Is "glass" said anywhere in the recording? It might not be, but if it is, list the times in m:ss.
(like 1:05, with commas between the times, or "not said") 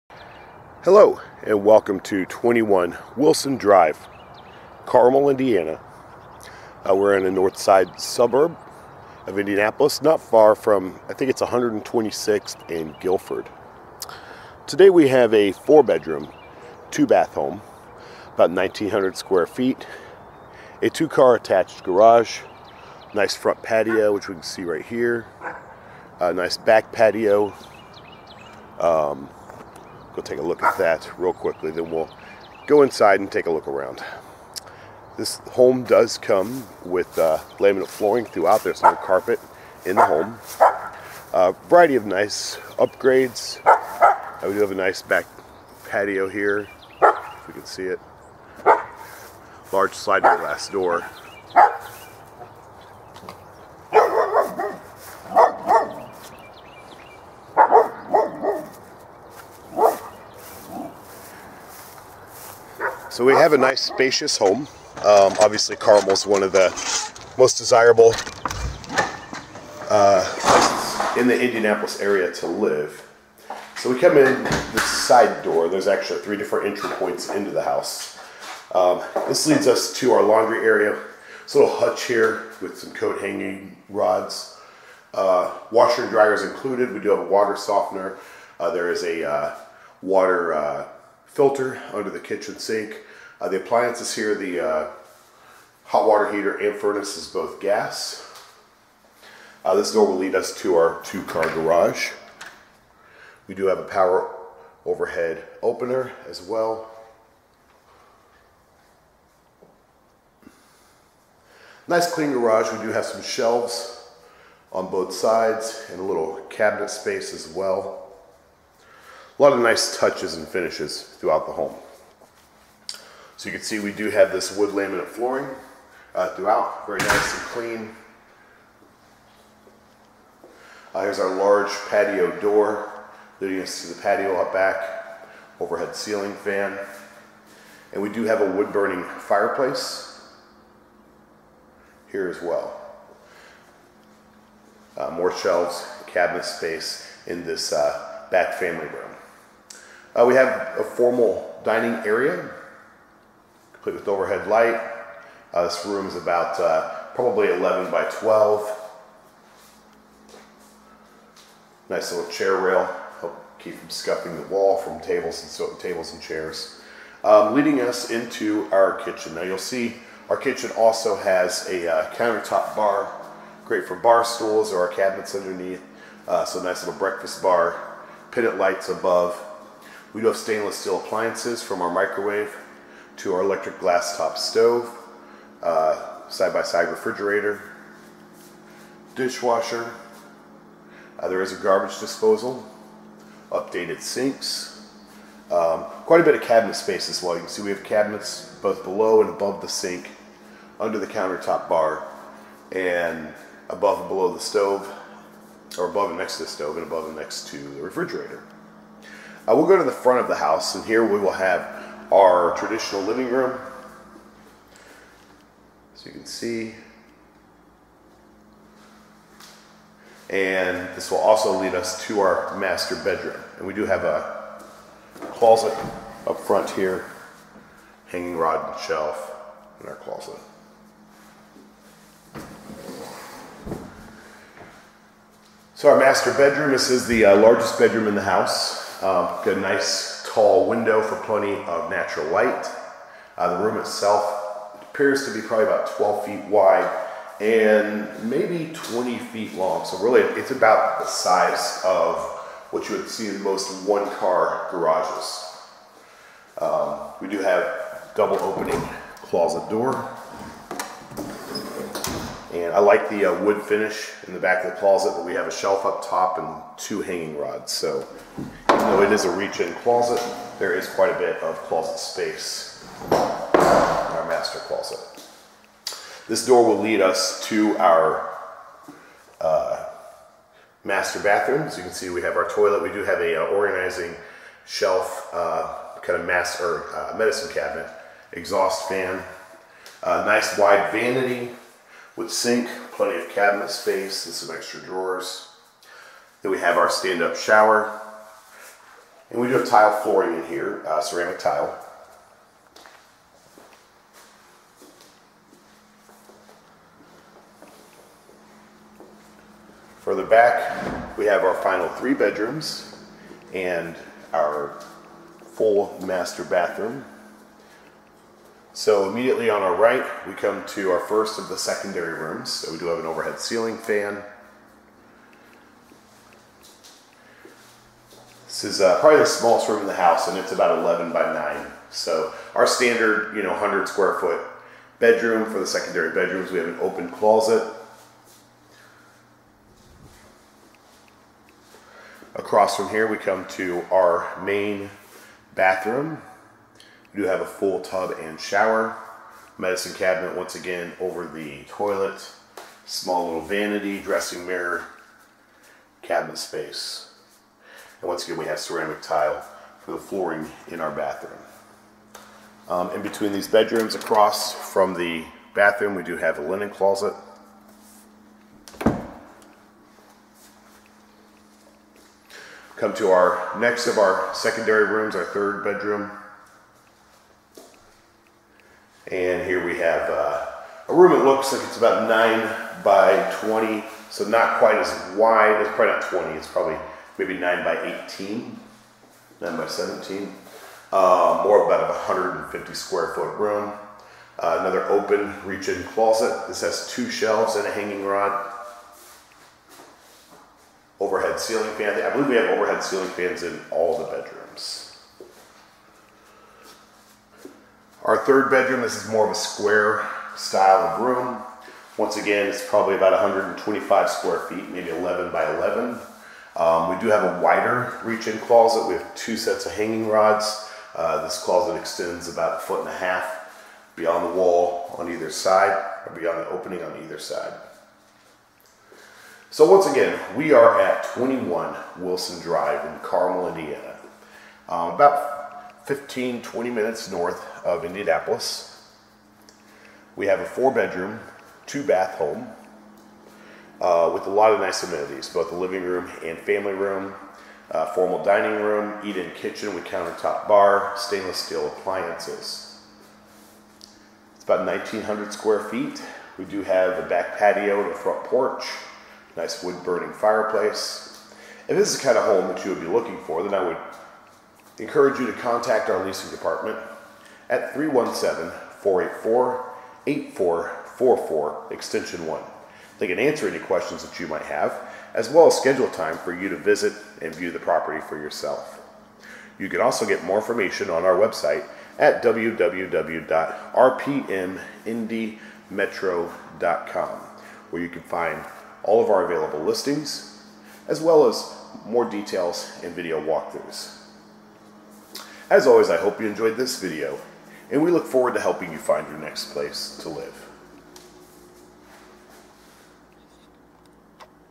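0:50, 3:03.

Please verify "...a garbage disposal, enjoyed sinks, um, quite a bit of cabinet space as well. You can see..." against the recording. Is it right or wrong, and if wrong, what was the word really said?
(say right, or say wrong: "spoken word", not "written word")
wrong: "updated", not "enjoyed".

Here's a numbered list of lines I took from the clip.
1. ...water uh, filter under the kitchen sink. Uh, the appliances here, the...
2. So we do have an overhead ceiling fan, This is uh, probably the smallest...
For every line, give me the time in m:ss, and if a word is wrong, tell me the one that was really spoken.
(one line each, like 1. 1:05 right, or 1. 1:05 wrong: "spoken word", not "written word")
1. 1:30 right
2. 5:22 right.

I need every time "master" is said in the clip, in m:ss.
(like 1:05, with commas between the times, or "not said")
3:42, 3:55, 4:34, 4:40, 5:16.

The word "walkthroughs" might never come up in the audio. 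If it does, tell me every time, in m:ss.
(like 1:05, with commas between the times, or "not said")
8:13.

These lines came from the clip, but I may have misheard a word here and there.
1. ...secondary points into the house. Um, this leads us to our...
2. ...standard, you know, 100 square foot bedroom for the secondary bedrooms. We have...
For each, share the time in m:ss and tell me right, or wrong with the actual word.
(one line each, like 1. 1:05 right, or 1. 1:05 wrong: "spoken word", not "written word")
1. 1:16 wrong: "entry", not "secondary"
2. 5:32 right.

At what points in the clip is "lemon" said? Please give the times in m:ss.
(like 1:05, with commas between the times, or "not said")
not said.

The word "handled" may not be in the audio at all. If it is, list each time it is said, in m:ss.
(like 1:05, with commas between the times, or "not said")
not said.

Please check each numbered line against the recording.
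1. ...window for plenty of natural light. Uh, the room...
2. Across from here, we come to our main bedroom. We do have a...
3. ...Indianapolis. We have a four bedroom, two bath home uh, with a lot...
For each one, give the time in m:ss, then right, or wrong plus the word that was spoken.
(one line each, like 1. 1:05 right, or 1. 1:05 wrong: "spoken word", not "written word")
1. 4:00 right
2. 5:42 wrong: "bathroom", not "bedroom"
3. 7:17 right.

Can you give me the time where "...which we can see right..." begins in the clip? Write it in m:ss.
0:24.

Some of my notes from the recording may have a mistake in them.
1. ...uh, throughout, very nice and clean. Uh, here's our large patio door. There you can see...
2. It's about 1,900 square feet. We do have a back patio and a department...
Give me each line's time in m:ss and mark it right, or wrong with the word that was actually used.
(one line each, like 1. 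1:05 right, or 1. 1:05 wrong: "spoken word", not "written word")
1. 2:06 right
2. 7:34 wrong: "front", not "department".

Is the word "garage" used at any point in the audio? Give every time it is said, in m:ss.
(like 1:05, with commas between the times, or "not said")
0:21, 1:41, 1:52, 4:14.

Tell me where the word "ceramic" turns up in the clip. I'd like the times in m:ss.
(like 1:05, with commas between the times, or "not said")
5:00, 5:58.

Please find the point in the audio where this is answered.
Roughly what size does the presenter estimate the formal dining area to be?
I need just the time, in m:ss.
2:37.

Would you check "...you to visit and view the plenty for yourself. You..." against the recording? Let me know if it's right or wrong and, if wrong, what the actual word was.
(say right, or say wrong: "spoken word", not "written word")
wrong: "property", not "plenty".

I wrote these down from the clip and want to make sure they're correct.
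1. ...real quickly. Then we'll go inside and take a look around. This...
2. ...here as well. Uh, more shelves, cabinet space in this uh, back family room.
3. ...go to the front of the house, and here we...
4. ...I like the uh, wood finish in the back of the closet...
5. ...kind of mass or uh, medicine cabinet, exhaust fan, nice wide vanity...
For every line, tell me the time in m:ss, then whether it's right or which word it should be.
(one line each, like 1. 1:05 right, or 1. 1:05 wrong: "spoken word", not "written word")
1. 0:31 right
2. 2:22 right
3. 3:29 right
4. 4:22 right
5. 4:46 right.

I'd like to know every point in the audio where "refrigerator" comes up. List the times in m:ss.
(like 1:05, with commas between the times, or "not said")
3:06, 3:27.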